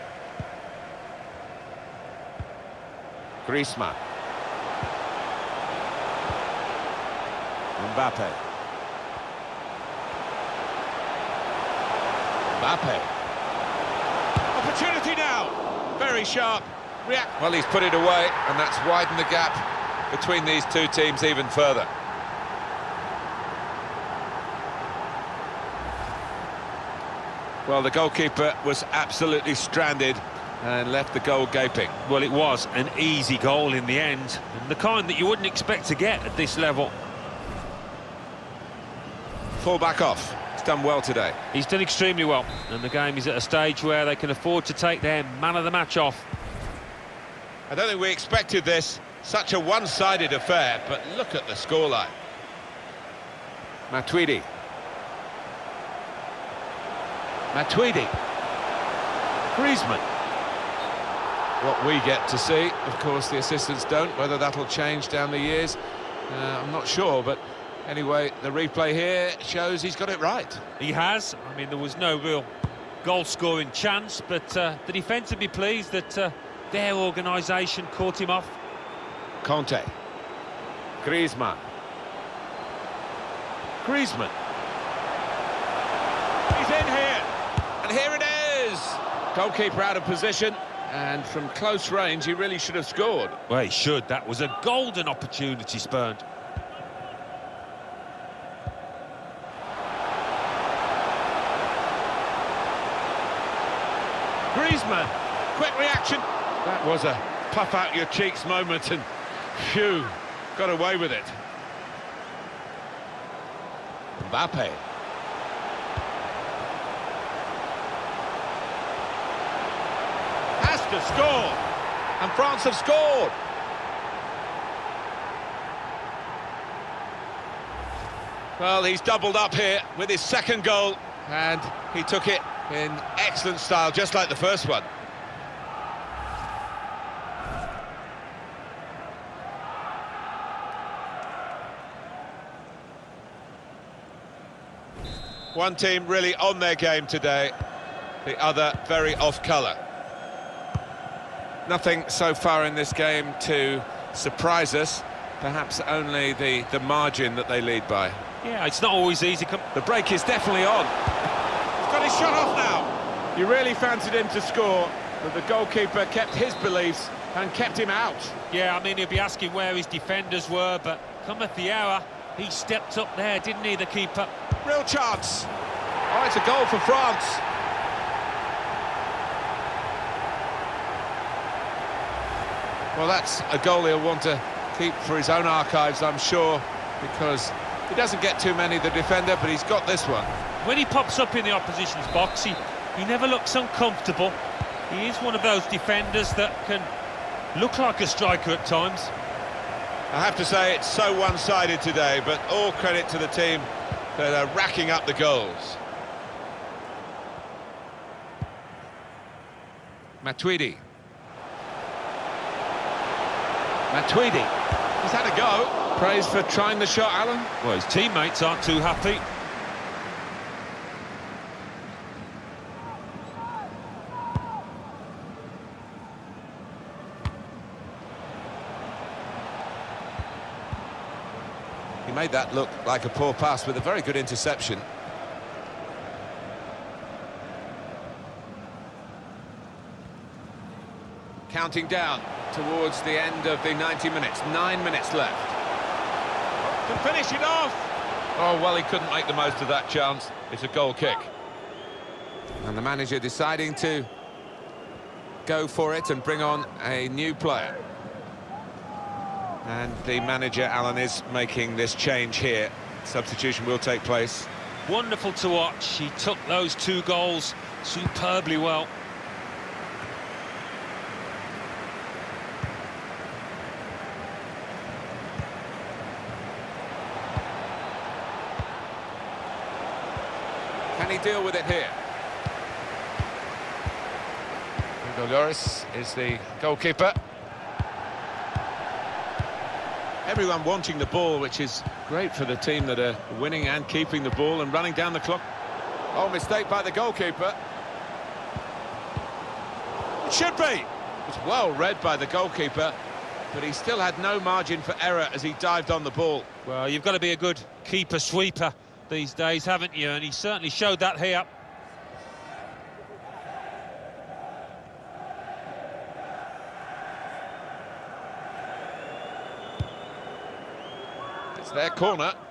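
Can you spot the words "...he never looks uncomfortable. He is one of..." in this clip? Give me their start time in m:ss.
3:12.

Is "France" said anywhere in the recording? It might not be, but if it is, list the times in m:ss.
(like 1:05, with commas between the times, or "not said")
2:02, 2:56.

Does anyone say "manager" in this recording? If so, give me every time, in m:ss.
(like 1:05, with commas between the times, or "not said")
4:12, 4:20.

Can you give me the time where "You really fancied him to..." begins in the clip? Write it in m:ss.
2:43.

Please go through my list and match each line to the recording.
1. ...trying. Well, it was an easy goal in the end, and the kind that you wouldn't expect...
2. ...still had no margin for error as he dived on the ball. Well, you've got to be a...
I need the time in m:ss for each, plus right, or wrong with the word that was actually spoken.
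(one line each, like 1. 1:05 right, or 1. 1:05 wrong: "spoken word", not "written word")
1. 0:31 wrong: "gaping", not "trying"
2. 5:03 right.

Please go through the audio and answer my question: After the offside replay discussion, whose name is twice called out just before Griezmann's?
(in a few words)
Kante.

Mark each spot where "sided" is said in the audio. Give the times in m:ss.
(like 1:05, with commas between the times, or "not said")
0:49, 3:21.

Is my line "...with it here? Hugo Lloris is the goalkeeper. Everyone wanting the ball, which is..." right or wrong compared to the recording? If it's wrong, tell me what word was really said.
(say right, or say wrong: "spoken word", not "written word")
right.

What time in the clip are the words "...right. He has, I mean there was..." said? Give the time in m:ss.
1:10.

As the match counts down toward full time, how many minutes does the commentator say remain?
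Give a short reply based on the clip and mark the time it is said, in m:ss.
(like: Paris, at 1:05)
9, at 4:04.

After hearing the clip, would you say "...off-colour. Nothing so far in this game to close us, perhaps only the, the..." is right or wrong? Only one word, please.
wrong.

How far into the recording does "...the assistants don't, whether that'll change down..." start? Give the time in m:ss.
1:03.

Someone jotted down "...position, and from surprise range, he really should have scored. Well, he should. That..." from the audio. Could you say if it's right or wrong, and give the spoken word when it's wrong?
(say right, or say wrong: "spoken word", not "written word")
wrong: "close", not "surprise".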